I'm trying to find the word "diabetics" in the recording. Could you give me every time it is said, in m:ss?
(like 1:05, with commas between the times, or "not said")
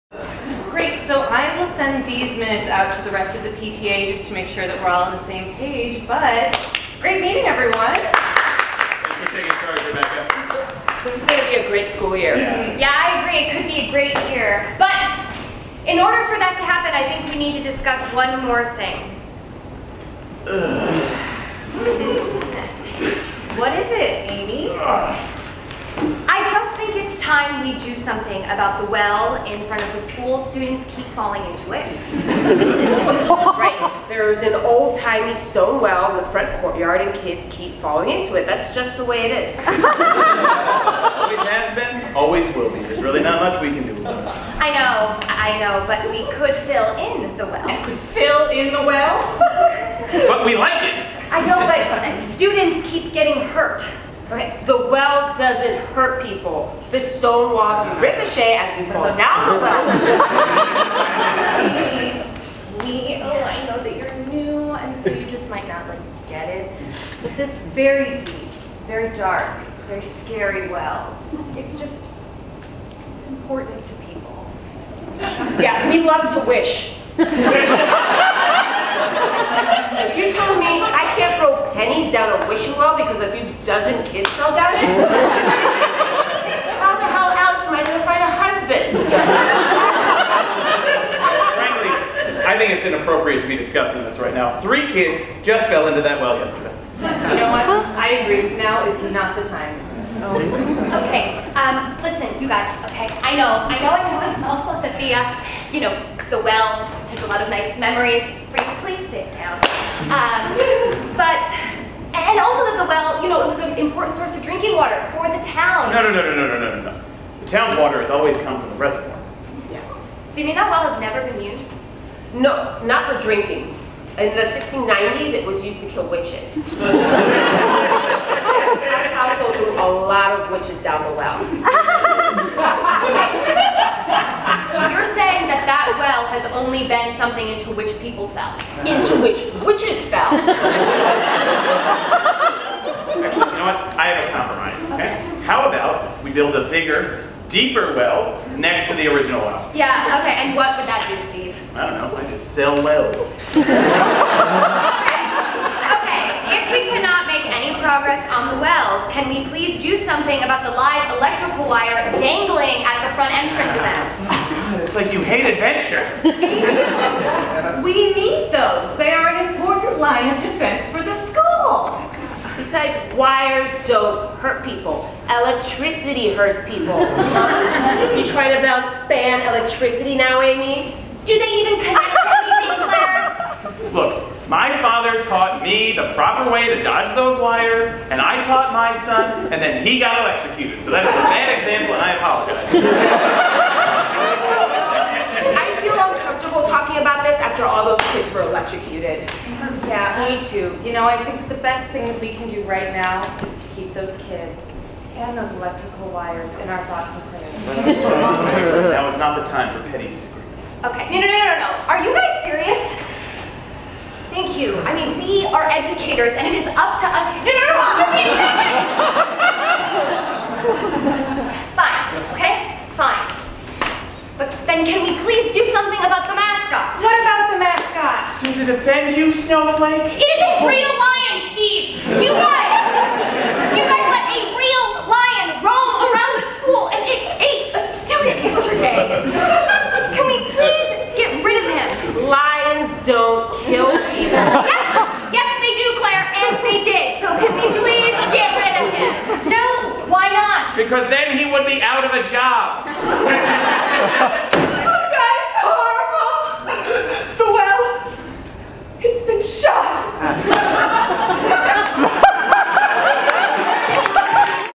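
not said.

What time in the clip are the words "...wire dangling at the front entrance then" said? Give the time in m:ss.
2:41.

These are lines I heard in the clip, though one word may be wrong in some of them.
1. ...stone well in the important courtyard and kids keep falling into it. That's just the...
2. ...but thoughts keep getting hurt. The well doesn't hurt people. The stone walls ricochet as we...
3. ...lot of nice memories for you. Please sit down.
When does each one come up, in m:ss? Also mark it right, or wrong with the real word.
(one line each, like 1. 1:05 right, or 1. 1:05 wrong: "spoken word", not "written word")
1. 0:35 wrong: "front", not "important"
2. 0:51 wrong: "students", not "thoughts"
3. 1:47 right.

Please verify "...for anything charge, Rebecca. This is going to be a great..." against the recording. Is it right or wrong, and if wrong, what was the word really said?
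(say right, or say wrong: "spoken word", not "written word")
wrong: "taking", not "anything".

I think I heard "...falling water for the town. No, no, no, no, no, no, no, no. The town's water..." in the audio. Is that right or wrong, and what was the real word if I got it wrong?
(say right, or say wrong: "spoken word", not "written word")
wrong: "drinking", not "falling".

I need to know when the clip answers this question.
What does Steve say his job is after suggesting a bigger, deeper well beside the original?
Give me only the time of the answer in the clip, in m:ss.
2:32.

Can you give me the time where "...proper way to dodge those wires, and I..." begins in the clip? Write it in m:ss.
3:06.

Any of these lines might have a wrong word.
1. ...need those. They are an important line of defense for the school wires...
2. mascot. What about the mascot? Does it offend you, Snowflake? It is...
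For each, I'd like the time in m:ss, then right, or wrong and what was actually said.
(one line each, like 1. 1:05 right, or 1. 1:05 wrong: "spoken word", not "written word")
1. 2:48 right
2. 3:46 right.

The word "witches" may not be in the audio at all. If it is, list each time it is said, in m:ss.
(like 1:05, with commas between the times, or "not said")
2:06, 2:10, 2:19.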